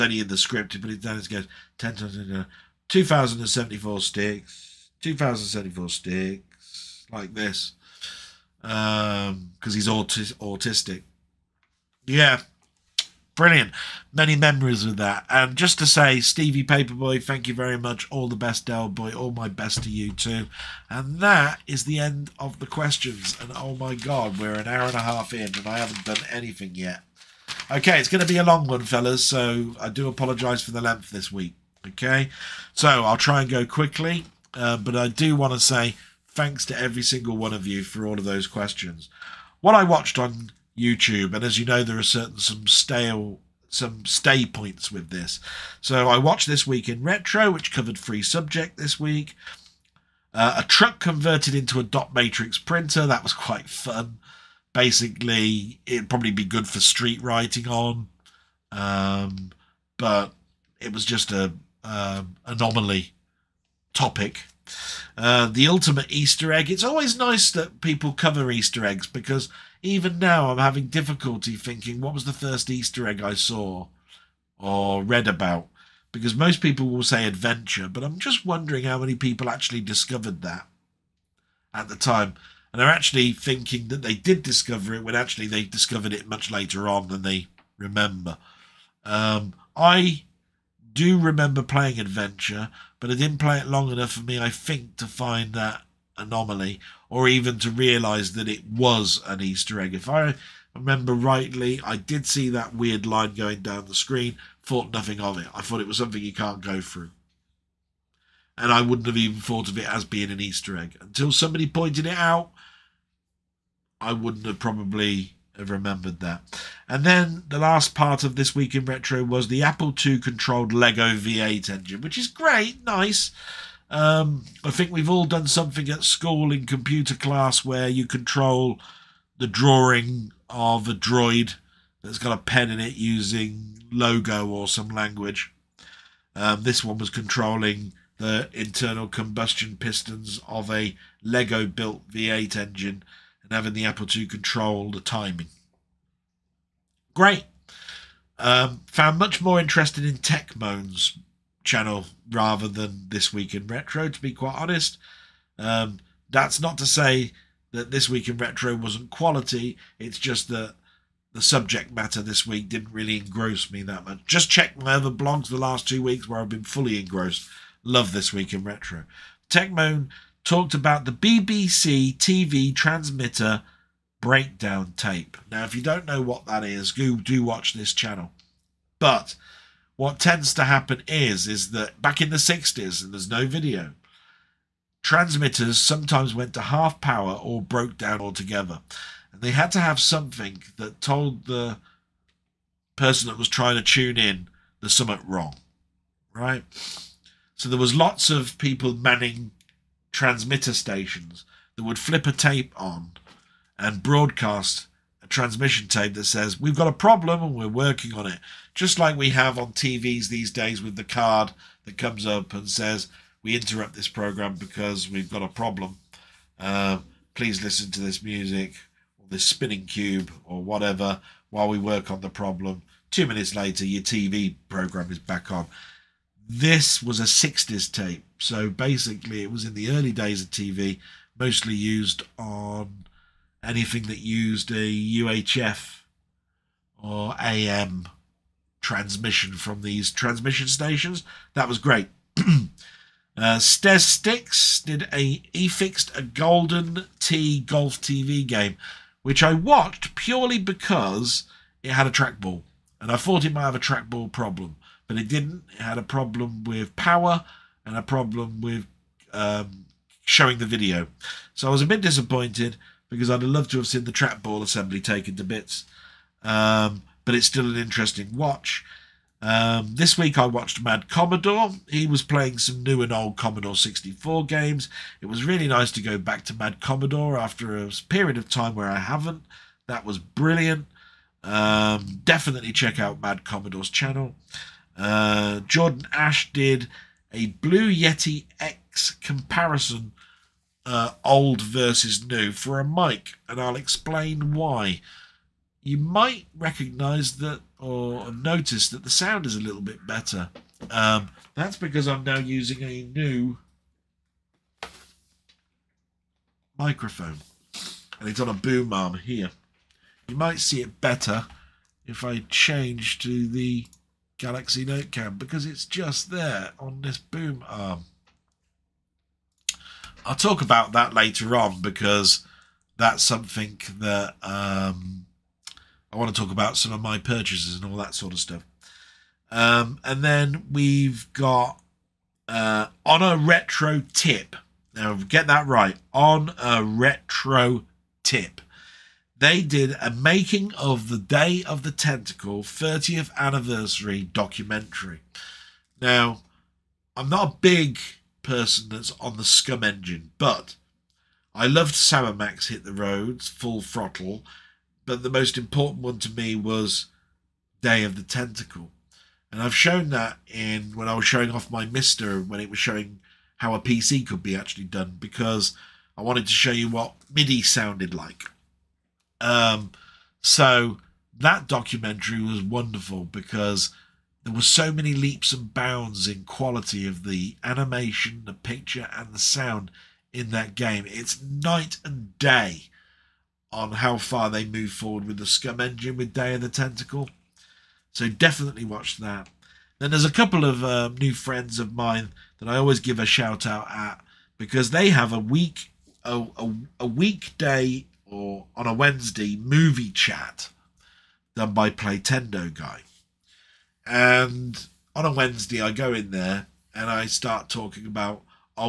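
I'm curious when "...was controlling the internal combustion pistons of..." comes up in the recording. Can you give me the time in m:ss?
2:16.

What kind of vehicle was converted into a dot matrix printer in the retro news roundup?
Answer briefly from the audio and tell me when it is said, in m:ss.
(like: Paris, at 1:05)
A truck, at 0:50.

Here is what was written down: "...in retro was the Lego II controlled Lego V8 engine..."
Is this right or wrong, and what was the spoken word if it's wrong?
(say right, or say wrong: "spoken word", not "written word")
wrong: "Apple", not "Lego".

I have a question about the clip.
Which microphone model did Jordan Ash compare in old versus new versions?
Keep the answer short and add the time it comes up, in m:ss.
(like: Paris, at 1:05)
Blue Yeti X, at 4:47.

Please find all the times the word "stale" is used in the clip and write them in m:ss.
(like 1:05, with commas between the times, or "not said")
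0:42.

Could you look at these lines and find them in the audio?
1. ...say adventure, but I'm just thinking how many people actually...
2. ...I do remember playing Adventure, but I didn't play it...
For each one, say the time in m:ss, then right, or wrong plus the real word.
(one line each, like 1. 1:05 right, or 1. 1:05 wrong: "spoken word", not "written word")
1. 1:17 wrong: "wondering", not "thinking"
2. 1:29 right.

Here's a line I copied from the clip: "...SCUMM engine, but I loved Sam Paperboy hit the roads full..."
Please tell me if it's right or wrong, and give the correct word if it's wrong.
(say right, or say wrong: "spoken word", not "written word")
wrong: "Max", not "Paperboy".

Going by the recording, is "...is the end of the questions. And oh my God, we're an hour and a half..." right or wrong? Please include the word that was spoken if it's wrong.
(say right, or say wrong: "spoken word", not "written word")
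right.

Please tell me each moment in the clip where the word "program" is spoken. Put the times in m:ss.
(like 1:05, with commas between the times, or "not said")
3:34, 3:44.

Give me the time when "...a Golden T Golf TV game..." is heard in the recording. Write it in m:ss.
4:06.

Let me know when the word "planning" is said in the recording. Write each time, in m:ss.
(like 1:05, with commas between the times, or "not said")
not said.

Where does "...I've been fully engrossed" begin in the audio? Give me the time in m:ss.
2:46.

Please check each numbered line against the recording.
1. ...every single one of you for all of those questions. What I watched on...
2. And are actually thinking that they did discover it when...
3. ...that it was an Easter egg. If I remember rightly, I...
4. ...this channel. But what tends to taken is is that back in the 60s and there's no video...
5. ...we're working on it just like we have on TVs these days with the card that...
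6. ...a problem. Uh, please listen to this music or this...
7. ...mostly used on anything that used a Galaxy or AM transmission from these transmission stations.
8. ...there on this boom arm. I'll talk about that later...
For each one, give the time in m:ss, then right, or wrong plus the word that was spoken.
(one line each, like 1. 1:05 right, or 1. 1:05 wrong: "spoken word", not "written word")
1. 0:36 right
2. 1:22 right
3. 1:38 right
4. 2:57 wrong: "happen", not "taken"
5. 3:27 right
6. 3:35 right
7. 3:51 wrong: "UHF", not "Galaxy"
8. 5:16 right.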